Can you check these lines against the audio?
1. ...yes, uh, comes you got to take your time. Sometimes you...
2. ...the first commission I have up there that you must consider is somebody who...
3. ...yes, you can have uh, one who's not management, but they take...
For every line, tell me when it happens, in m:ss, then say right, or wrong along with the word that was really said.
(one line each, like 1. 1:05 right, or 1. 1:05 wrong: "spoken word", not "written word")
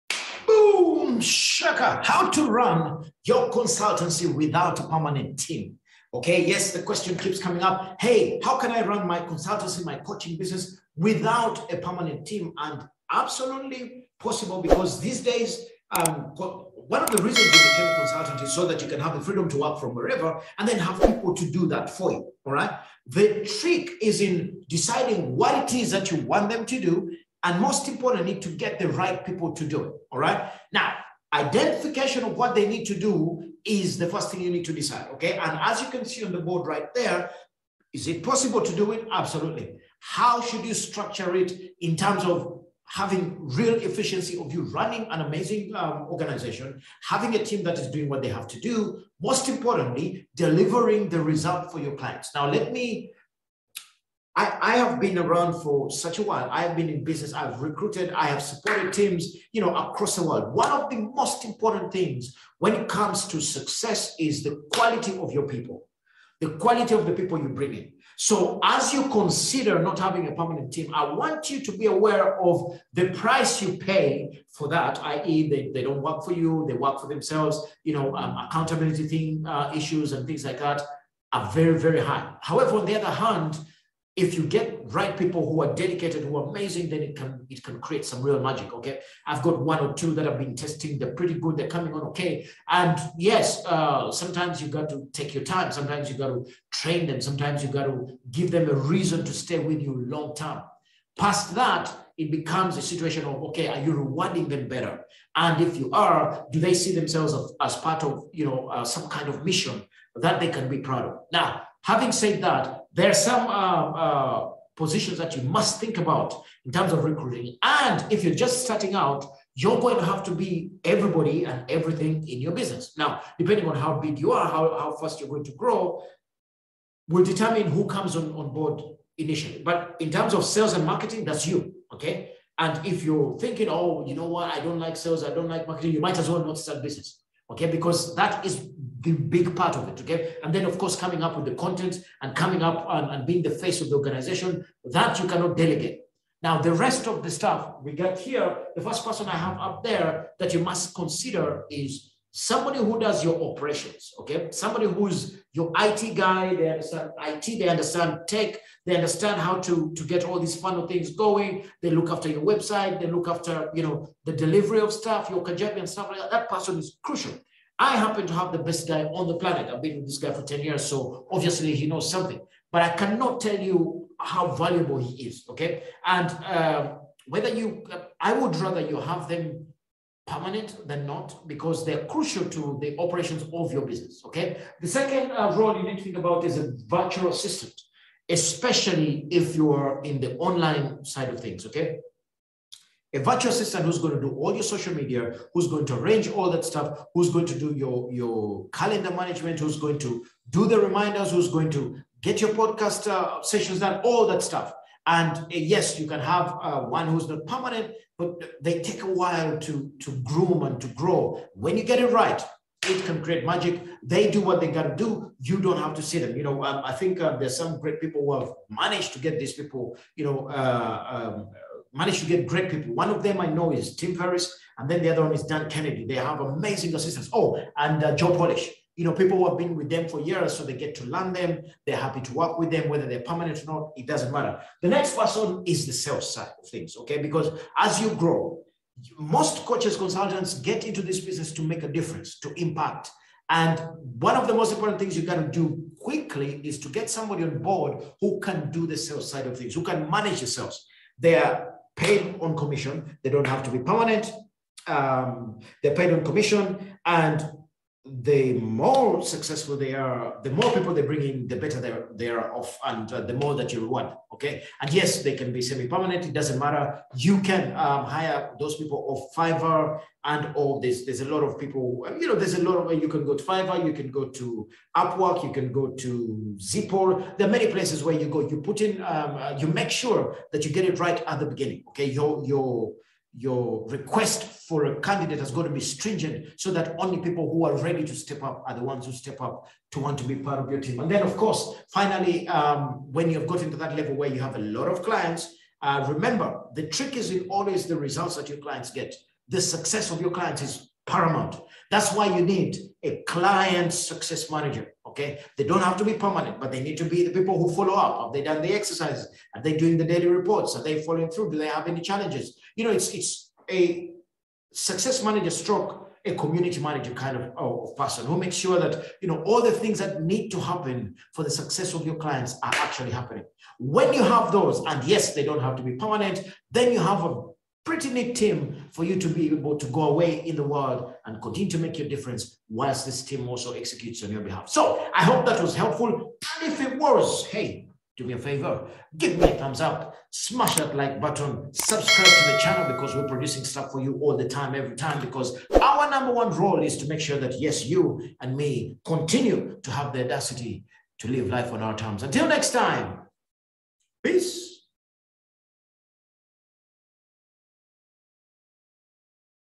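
1. 1:33 wrong: "sometimes", not "comes"
2. 2:28 wrong: "person", not "commission"
3. 3:25 wrong: "permanent", not "management".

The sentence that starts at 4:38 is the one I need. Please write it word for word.
You put in, um, uh, you make sure that you get it right at the beginning.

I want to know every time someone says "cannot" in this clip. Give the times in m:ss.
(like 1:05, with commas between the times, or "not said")
2:25, 2:52.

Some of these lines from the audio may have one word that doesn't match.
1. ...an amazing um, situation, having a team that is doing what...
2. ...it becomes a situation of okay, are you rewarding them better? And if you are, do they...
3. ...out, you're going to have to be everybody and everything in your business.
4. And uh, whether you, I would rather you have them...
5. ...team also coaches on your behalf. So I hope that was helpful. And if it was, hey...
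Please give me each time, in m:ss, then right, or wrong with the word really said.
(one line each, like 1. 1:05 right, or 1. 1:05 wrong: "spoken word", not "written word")
1. 0:45 wrong: "organization", not "situation"
2. 1:42 right
3. 1:58 right
4. 2:56 right
5. 5:33 wrong: "executes", not "coaches".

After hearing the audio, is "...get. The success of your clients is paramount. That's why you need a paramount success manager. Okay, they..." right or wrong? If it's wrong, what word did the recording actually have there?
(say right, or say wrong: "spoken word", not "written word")
wrong: "client", not "paramount".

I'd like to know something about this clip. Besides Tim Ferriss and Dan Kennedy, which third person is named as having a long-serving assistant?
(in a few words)
Joe Polish.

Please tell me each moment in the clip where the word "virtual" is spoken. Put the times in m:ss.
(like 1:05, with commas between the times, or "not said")
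3:06, 3:13.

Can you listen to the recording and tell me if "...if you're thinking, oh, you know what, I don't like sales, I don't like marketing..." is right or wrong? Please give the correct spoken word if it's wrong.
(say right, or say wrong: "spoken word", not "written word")
right.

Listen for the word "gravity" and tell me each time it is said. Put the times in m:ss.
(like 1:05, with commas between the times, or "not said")
not said.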